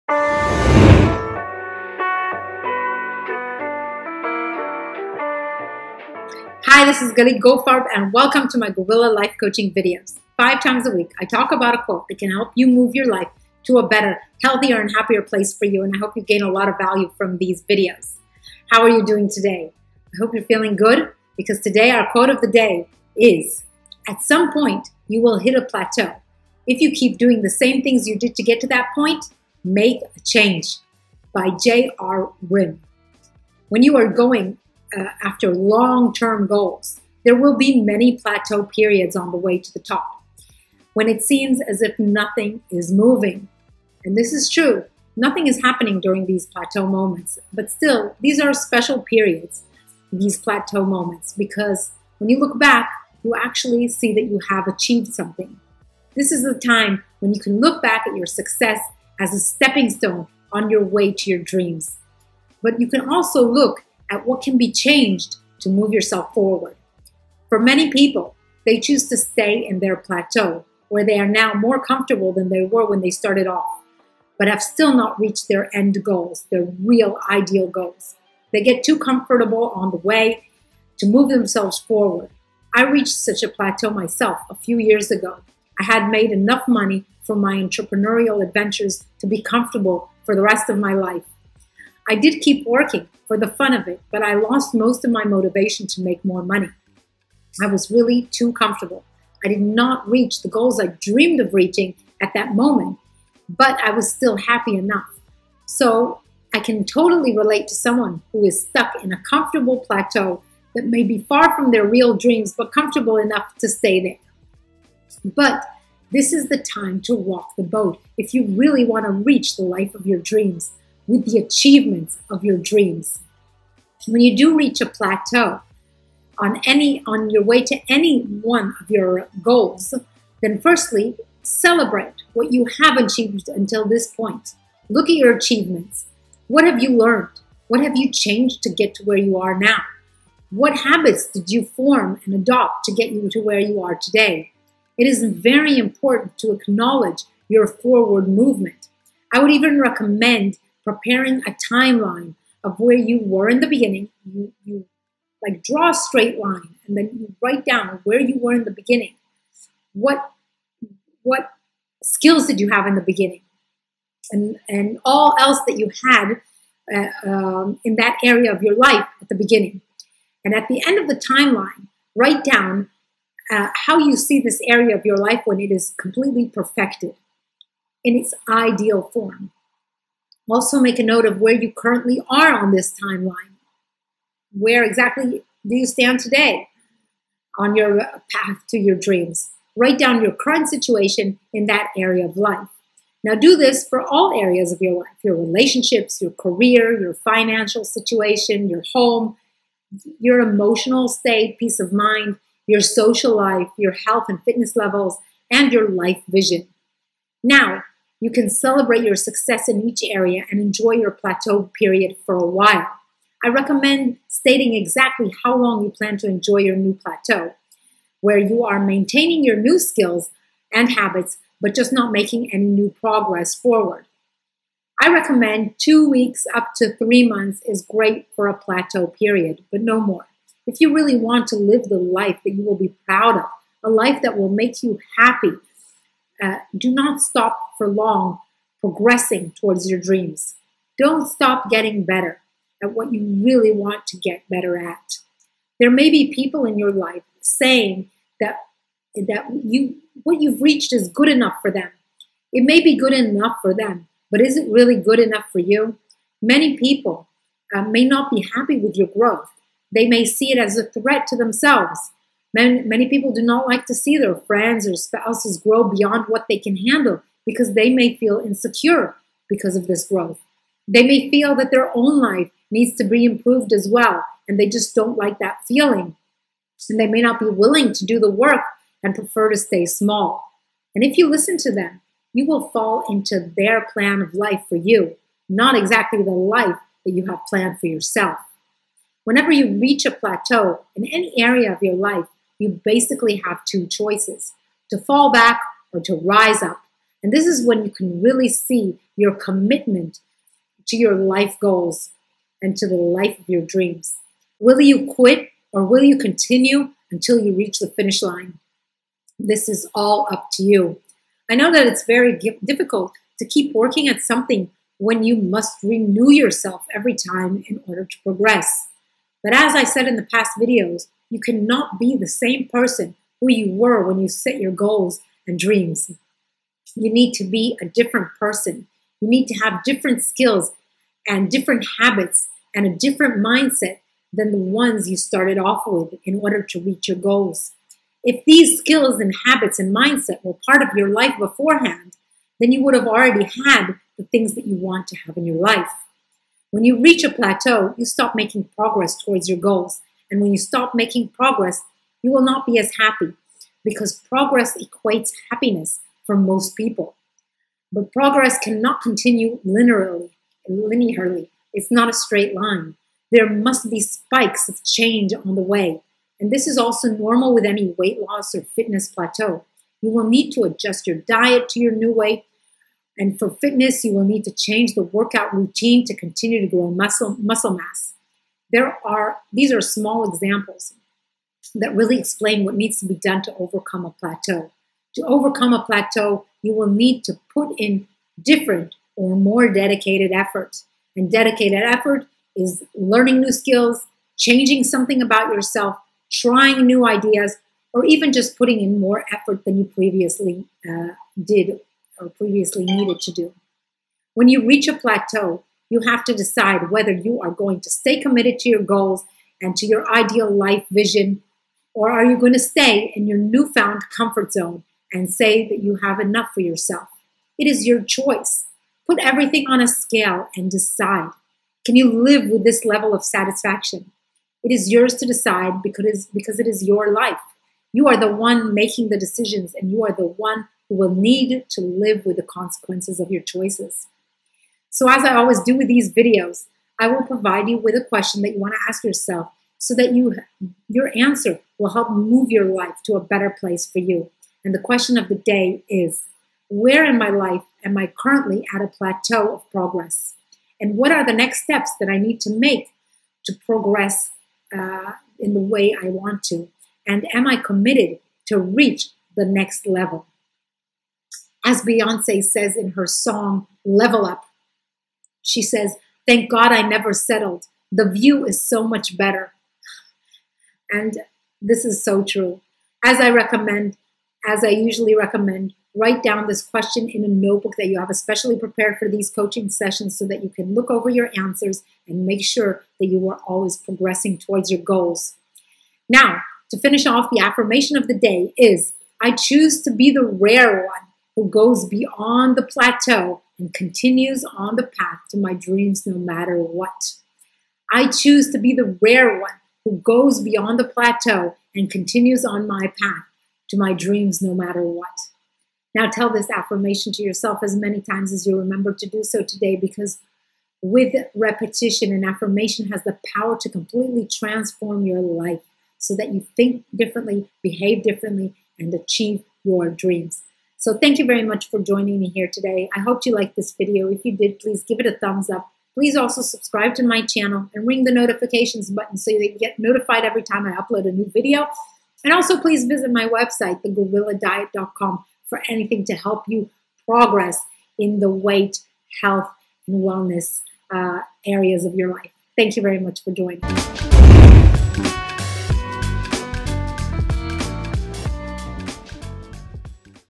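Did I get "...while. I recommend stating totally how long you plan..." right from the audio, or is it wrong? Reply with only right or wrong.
wrong.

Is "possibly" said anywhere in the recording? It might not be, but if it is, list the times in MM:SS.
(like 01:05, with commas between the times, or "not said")
not said.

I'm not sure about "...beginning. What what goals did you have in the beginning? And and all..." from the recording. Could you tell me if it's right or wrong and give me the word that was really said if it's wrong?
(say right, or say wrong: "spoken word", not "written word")
wrong: "skills", not "goals".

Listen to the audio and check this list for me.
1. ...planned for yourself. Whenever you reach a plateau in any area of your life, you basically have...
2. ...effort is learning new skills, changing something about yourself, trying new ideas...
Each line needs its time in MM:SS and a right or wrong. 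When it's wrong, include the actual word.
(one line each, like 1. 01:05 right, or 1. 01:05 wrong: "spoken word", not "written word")
1. 04:47 right
2. 06:31 right.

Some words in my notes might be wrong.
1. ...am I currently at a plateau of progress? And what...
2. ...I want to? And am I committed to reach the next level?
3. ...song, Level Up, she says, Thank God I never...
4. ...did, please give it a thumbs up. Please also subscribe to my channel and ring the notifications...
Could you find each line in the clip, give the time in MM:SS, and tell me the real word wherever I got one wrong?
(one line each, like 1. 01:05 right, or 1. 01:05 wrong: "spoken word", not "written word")
1. 07:27 right
2. 07:35 right
3. 07:43 right
4. 08:44 right.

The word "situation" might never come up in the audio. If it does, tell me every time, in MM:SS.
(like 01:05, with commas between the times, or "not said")
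03:10, 03:17.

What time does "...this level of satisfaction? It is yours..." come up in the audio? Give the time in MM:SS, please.
07:02.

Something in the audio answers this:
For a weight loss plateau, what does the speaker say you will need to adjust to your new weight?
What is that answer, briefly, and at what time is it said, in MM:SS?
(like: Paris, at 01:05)
diet, at 06:11.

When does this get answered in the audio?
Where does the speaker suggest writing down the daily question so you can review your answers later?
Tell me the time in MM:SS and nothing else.
07:57.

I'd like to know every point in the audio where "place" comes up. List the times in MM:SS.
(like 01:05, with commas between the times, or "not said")
00:15, 07:23.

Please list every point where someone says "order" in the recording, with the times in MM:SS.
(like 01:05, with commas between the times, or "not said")
05:17, 05:36.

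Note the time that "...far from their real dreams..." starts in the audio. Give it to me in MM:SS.
01:51.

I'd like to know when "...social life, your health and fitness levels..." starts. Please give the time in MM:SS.
03:22.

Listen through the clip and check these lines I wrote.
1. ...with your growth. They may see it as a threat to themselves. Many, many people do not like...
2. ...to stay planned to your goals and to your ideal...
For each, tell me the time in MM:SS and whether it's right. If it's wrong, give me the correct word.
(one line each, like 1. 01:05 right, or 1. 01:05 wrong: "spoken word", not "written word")
1. 04:18 right
2. 06:47 wrong: "committed", not "planned".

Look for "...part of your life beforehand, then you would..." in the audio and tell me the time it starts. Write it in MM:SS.
05:40.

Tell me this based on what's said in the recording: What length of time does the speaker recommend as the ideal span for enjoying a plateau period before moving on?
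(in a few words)
2 weeks to 3 months.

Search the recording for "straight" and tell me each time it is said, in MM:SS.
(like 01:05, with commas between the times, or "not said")
02:35, 06:02.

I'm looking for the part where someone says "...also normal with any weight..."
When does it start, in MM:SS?
06:06.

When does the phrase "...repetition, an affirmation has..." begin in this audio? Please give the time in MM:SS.
08:31.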